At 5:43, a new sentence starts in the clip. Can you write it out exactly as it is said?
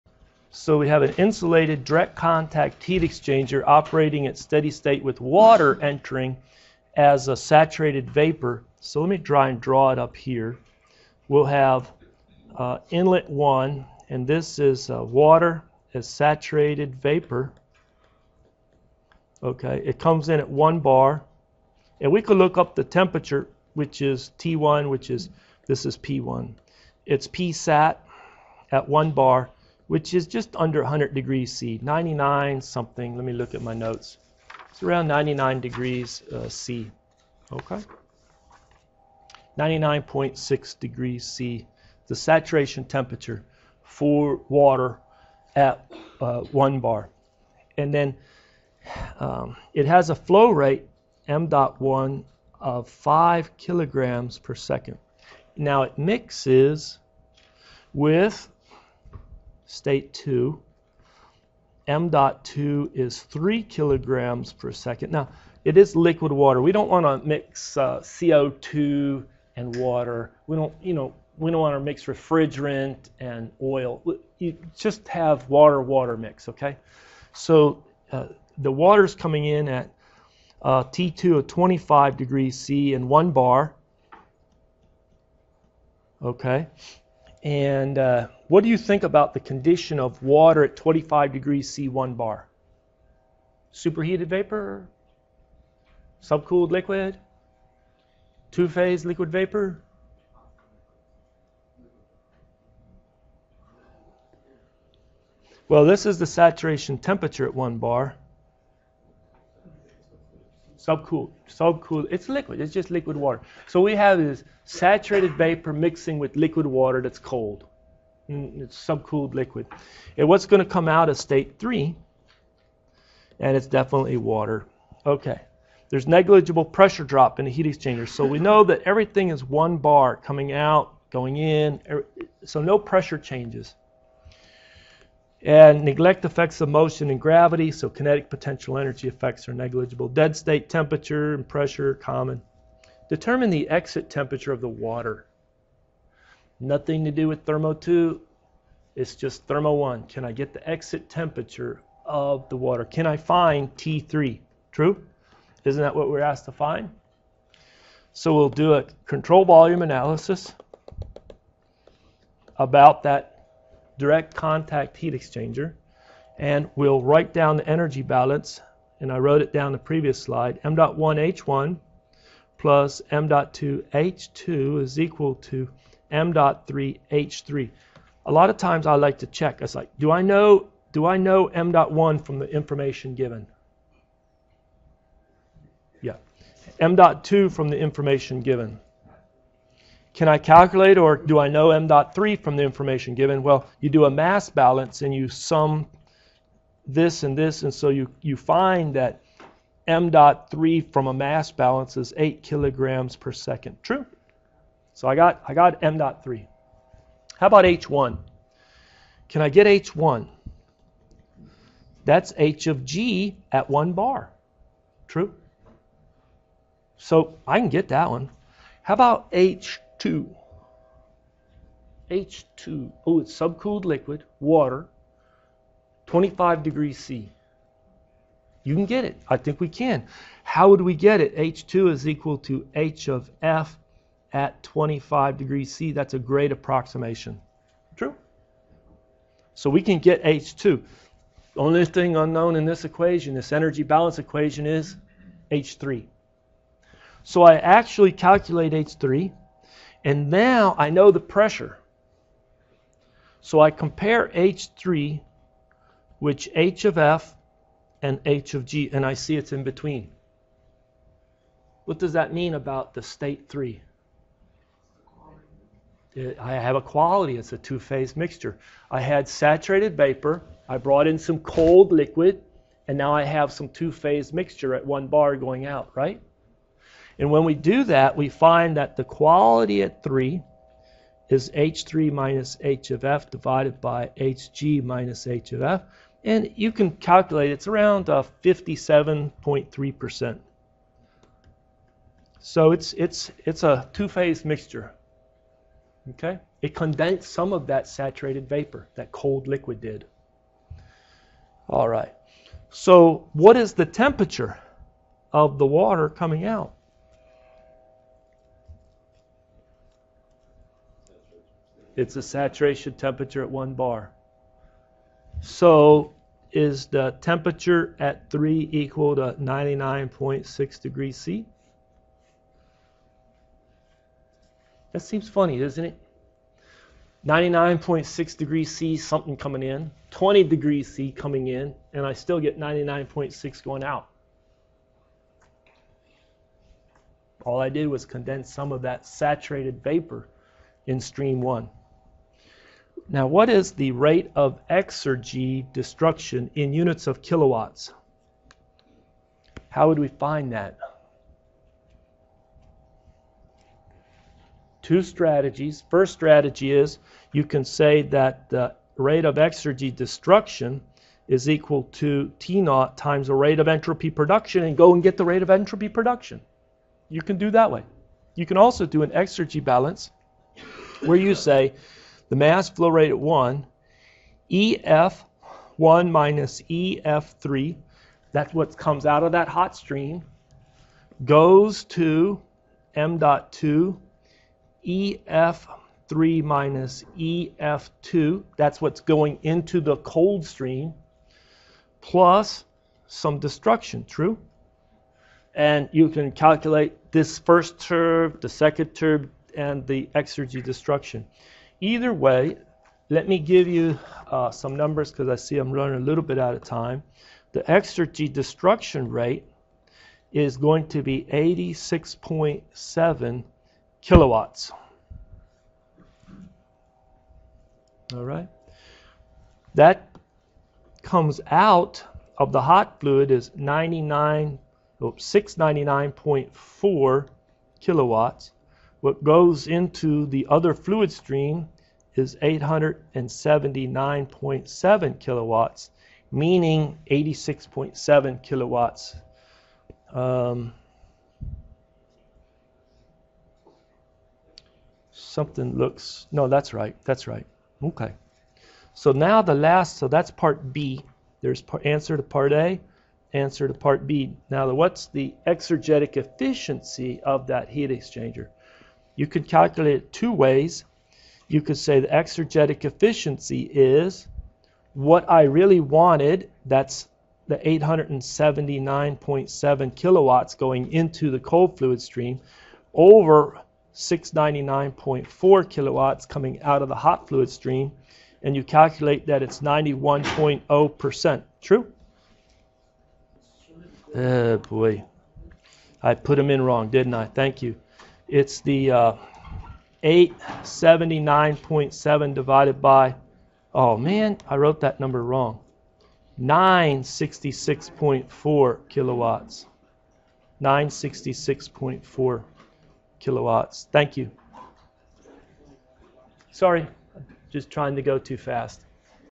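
Now, what is the rate of exergy destruction in units of kilowatts?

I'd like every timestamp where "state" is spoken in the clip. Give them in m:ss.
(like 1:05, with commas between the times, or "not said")
0:04, 0:59, 2:01, 2:20, 4:23.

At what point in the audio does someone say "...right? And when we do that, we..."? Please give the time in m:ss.
4:35.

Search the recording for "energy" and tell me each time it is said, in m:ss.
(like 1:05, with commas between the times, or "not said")
2:18, 2:47, 4:03.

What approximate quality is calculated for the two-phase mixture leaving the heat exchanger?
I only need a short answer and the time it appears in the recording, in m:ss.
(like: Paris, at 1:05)
57.3%, at 4:48.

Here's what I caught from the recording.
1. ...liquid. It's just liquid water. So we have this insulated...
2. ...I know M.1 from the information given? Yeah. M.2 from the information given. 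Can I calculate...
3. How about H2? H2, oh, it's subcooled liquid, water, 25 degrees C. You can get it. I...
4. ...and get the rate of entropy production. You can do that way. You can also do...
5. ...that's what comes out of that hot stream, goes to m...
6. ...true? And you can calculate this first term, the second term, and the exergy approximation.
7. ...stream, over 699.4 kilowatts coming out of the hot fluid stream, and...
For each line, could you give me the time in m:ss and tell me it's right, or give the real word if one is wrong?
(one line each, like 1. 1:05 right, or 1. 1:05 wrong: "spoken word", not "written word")
1. 1:52 wrong: "saturated", not "insulated"
2. 3:01 right
3. 3:38 right
4. 6:04 right
5. 6:18 right
6. 6:34 wrong: "destruction", not "approximation"
7. 7:52 right.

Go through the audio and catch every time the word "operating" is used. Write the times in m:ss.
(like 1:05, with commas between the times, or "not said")
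0:03.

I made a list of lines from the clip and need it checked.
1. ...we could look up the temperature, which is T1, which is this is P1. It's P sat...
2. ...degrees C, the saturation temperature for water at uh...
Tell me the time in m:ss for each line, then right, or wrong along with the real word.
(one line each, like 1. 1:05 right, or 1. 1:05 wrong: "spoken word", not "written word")
1. 0:22 right
2. 0:40 right.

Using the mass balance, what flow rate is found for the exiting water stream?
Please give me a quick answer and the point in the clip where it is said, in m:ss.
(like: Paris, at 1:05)
8 kg/s, at 3:22.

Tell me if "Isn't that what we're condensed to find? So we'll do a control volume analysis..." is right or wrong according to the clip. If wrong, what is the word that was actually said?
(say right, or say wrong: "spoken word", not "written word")
wrong: "asked", not "condensed".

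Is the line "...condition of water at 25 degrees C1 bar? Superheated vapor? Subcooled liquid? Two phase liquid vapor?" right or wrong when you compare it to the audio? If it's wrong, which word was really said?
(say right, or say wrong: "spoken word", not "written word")
right.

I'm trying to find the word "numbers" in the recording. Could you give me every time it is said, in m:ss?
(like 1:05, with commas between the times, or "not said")
6:44, 8:14.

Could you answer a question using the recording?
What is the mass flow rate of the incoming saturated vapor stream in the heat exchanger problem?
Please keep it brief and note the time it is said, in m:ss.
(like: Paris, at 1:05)
5 kg/s, at 0:52.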